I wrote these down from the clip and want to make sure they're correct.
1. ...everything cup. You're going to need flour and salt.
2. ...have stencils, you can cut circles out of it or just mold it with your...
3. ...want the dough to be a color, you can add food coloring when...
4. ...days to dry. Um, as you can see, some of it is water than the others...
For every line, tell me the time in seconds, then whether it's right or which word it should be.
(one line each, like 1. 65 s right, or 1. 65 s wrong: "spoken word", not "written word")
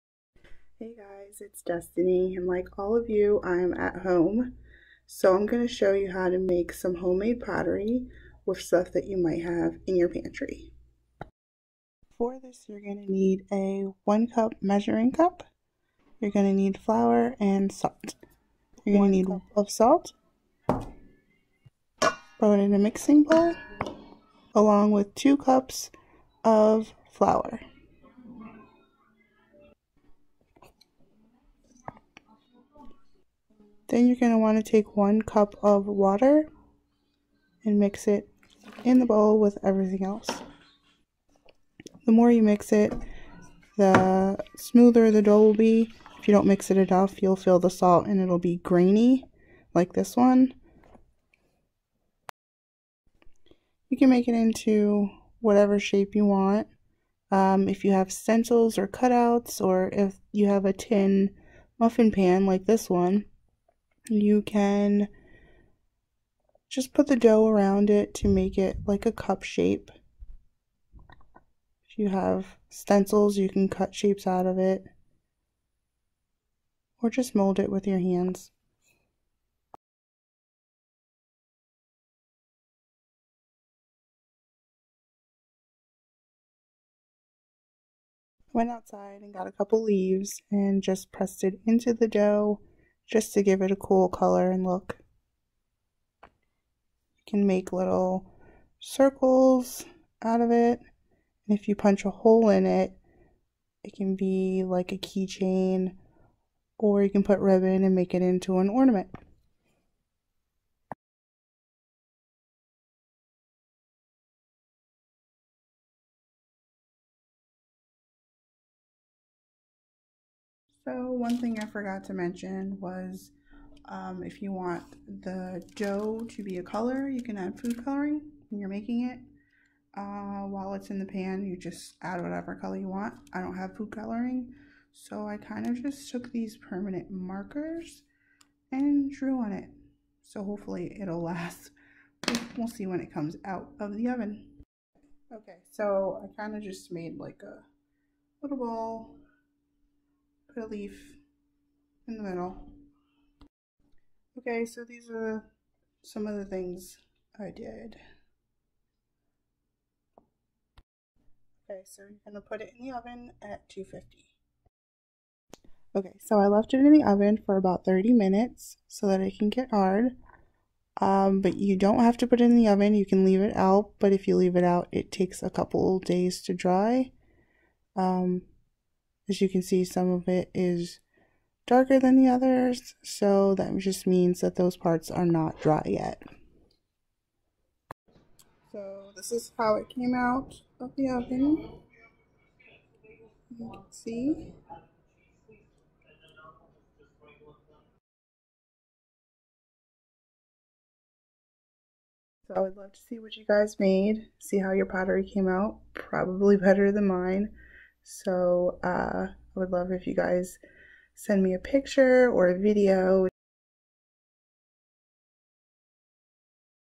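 1. 14 s wrong: "measuring", not "everything"
2. 72 s wrong: "shapes", not "circles"
3. 124 s right
4. 175 s wrong: "darker", not "water".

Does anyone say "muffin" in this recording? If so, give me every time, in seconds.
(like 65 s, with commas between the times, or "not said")
61 s.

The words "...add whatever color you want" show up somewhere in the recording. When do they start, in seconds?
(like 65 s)
132 s.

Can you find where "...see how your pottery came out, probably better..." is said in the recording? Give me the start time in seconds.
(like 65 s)
204 s.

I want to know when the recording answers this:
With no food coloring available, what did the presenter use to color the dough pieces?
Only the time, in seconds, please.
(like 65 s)
136 s.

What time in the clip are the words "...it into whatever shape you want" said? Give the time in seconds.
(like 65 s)
54 s.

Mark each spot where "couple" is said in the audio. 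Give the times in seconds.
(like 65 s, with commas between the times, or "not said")
89 s, 175 s.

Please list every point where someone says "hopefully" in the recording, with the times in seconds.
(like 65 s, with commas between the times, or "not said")
140 s.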